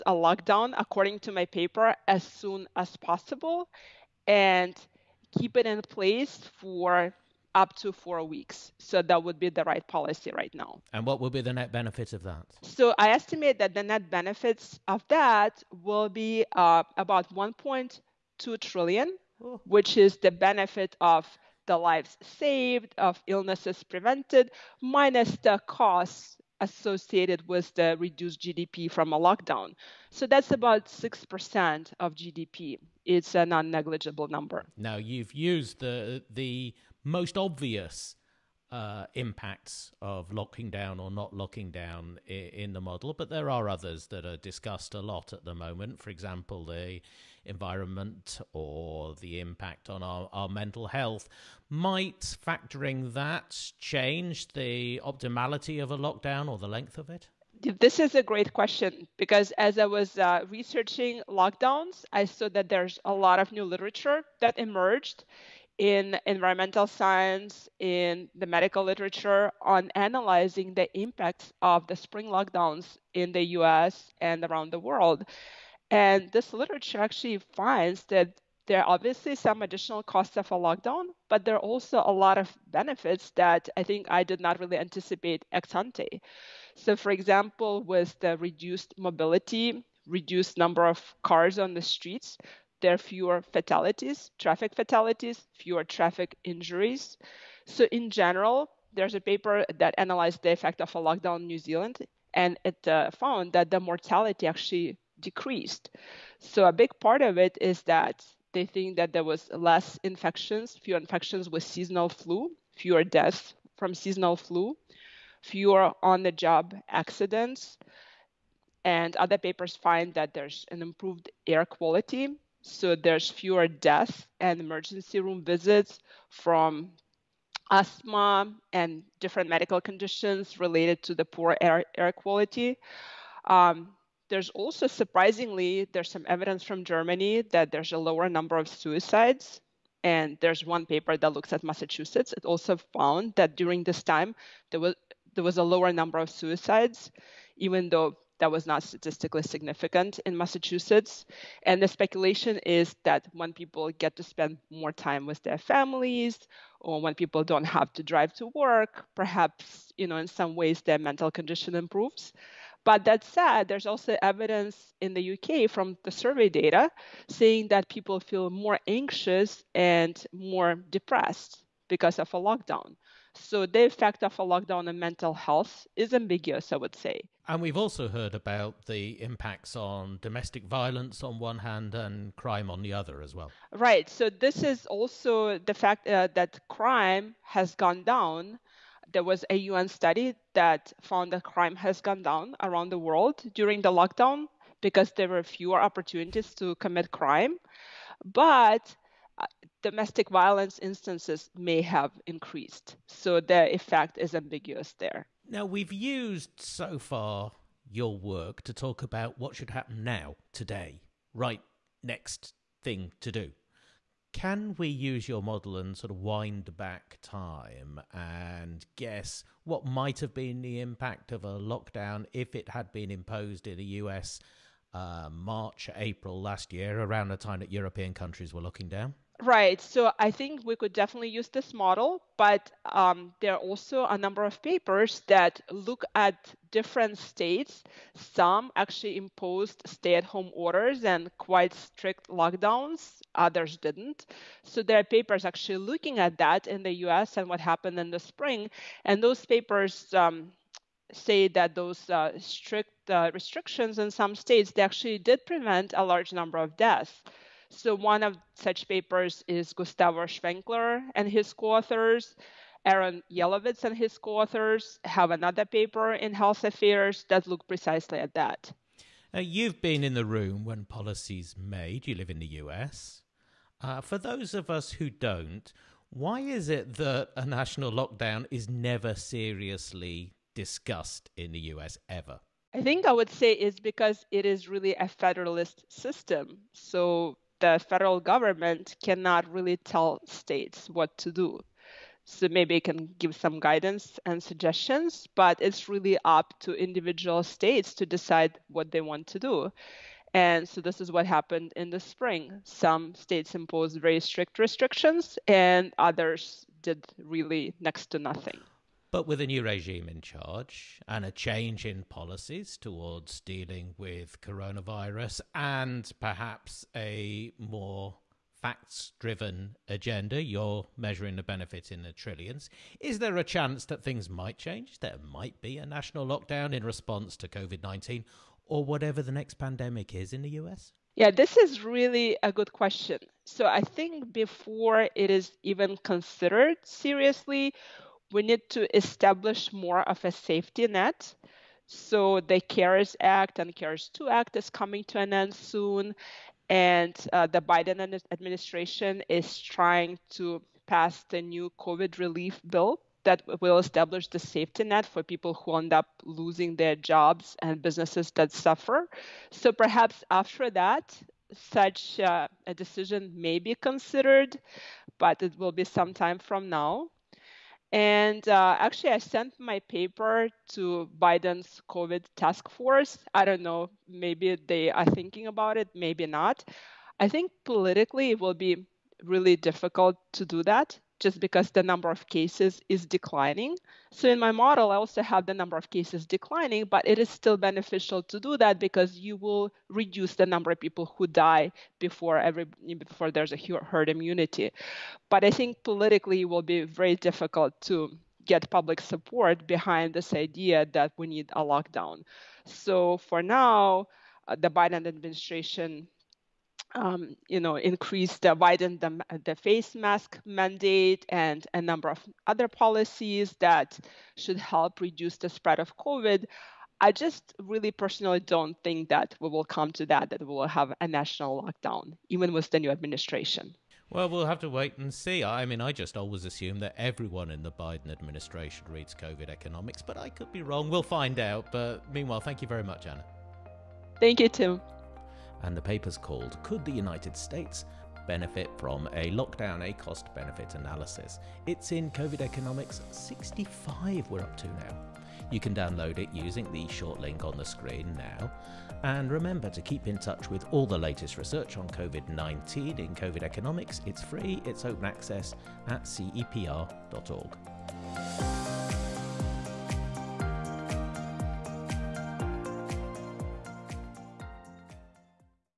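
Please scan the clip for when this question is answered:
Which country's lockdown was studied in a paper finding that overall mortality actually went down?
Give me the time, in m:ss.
1:41.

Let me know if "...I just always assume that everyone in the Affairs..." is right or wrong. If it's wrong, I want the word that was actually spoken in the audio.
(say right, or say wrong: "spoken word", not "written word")
wrong: "Biden", not "Affairs".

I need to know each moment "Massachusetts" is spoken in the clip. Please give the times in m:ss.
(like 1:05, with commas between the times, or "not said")
2:21, 2:30.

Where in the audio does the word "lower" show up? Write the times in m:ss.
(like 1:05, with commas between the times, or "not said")
2:17, 2:25.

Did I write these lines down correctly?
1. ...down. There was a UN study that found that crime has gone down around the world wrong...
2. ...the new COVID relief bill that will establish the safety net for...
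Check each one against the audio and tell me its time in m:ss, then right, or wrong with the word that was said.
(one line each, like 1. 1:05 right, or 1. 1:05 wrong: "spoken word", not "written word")
1. 3:08 wrong: "during", not "wrong"
2. 5:51 right.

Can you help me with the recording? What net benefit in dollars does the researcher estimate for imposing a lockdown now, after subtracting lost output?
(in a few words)
1.2 trillion.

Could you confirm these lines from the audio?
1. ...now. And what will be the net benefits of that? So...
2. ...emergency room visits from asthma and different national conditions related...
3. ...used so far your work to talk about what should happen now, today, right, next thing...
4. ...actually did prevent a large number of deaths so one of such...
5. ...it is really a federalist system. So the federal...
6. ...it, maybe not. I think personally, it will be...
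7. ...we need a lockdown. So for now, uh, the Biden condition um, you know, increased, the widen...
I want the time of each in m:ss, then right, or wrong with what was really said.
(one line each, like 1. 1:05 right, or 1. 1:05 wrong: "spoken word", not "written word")
1. 0:10 right
2. 2:04 wrong: "medical", not "national"
3. 3:25 right
4. 4:14 right
5. 4:44 right
6. 6:15 wrong: "politically", not "personally"
7. 6:41 wrong: "administration", not "condition".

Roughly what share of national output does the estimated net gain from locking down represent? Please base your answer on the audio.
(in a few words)
6%.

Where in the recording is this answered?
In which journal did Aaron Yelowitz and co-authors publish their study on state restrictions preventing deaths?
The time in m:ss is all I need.
4:26.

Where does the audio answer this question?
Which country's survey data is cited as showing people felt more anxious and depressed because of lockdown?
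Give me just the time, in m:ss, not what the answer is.
2:45.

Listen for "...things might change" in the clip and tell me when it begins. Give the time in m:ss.
5:24.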